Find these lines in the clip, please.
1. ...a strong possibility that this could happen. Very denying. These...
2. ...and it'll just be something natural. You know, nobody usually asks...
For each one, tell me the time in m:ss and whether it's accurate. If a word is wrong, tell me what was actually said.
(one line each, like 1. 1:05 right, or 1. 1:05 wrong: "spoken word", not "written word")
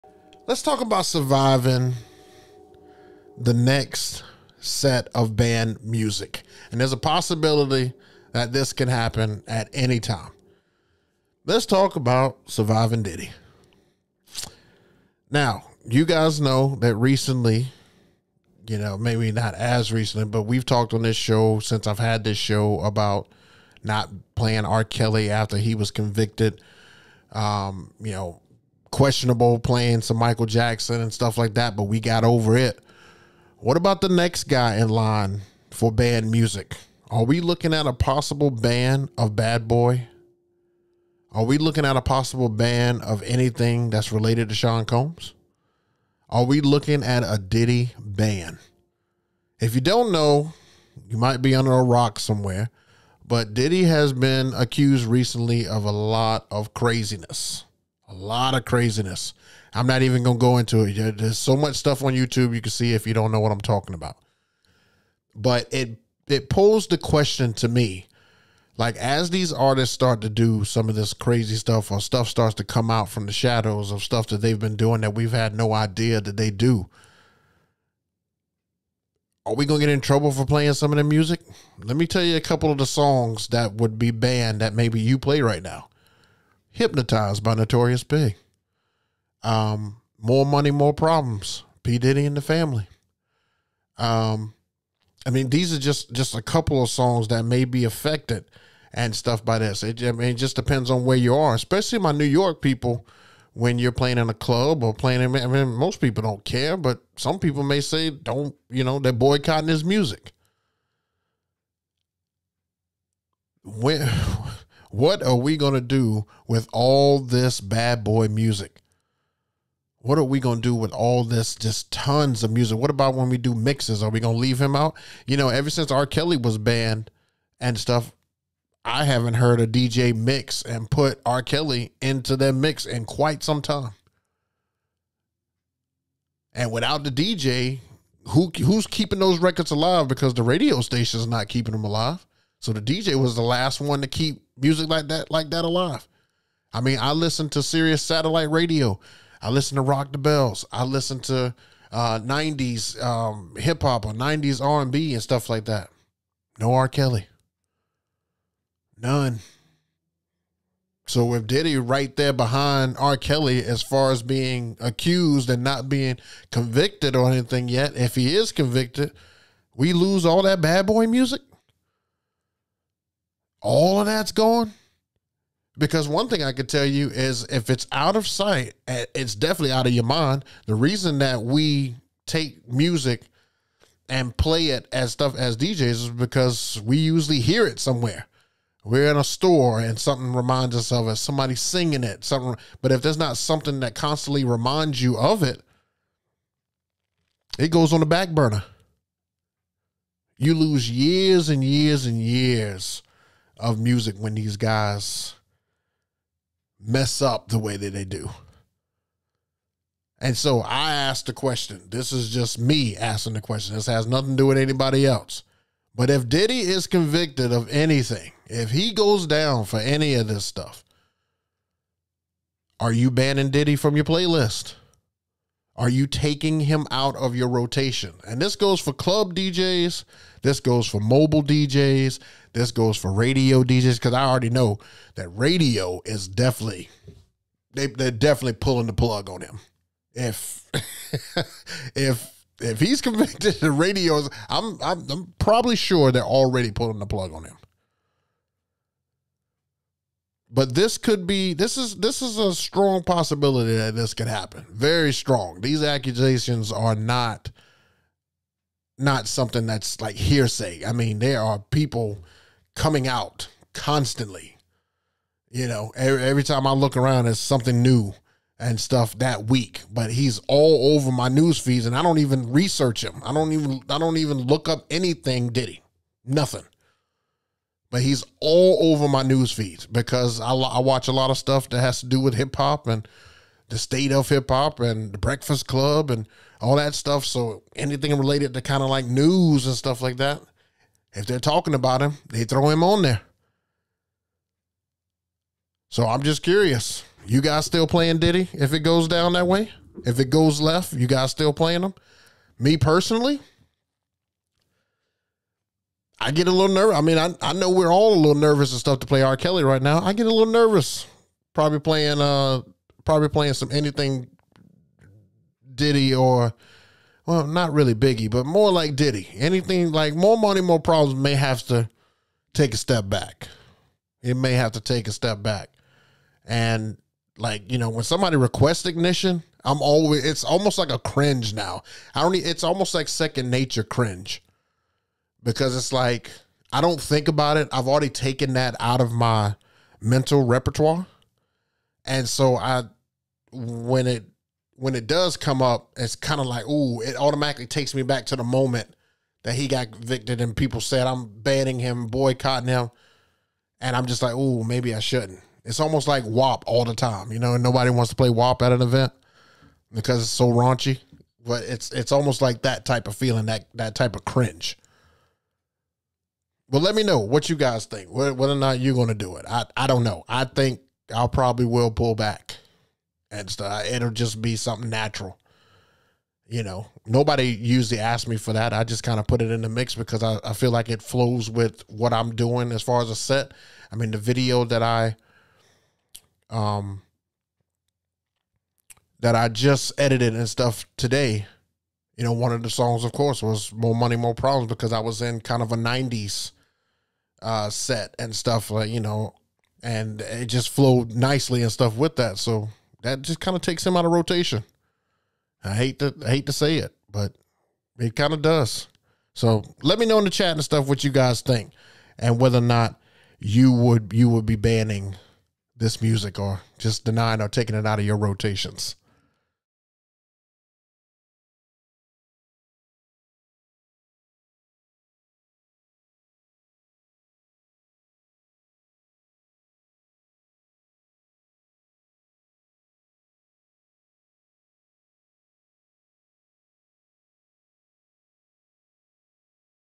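1. 4:12 wrong: "strong", not "denying"
2. 6:13 right.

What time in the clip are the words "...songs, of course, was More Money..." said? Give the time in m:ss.
6:32.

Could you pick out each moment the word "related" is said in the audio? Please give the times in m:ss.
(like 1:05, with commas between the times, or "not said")
0:44, 4:48.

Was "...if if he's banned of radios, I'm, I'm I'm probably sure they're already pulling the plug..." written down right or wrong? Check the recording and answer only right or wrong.
wrong.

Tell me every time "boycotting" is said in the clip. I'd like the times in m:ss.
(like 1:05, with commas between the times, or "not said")
1:49, 5:52.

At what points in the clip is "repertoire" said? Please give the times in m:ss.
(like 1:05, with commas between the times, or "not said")
5:40.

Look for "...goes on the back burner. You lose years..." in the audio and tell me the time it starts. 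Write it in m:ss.
3:17.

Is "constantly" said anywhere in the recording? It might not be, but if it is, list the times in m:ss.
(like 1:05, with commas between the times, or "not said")
3:13, 4:23.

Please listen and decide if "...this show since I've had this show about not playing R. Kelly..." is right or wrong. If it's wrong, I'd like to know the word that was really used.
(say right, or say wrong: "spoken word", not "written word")
right.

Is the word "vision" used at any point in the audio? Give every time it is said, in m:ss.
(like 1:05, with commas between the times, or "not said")
not said.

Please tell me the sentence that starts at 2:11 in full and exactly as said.
Kelly into their mix in quite some time.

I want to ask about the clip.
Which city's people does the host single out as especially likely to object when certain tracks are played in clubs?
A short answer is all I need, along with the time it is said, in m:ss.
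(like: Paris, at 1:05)
New York, at 1:42.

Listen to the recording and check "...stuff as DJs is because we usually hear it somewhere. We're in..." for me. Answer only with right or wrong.
right.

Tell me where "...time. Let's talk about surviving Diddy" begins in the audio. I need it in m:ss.
0:10.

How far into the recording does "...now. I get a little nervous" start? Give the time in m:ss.
5:09.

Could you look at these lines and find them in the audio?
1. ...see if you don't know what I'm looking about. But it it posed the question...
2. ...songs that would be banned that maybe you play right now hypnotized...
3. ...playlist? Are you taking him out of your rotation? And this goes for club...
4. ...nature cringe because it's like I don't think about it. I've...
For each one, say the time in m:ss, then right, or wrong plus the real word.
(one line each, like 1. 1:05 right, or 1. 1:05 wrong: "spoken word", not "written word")
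1. 1:02 wrong: "talking", not "looking"
2. 1:22 right
3. 3:44 right
4. 5:33 right.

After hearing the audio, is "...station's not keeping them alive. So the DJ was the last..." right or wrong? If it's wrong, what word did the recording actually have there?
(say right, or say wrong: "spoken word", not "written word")
right.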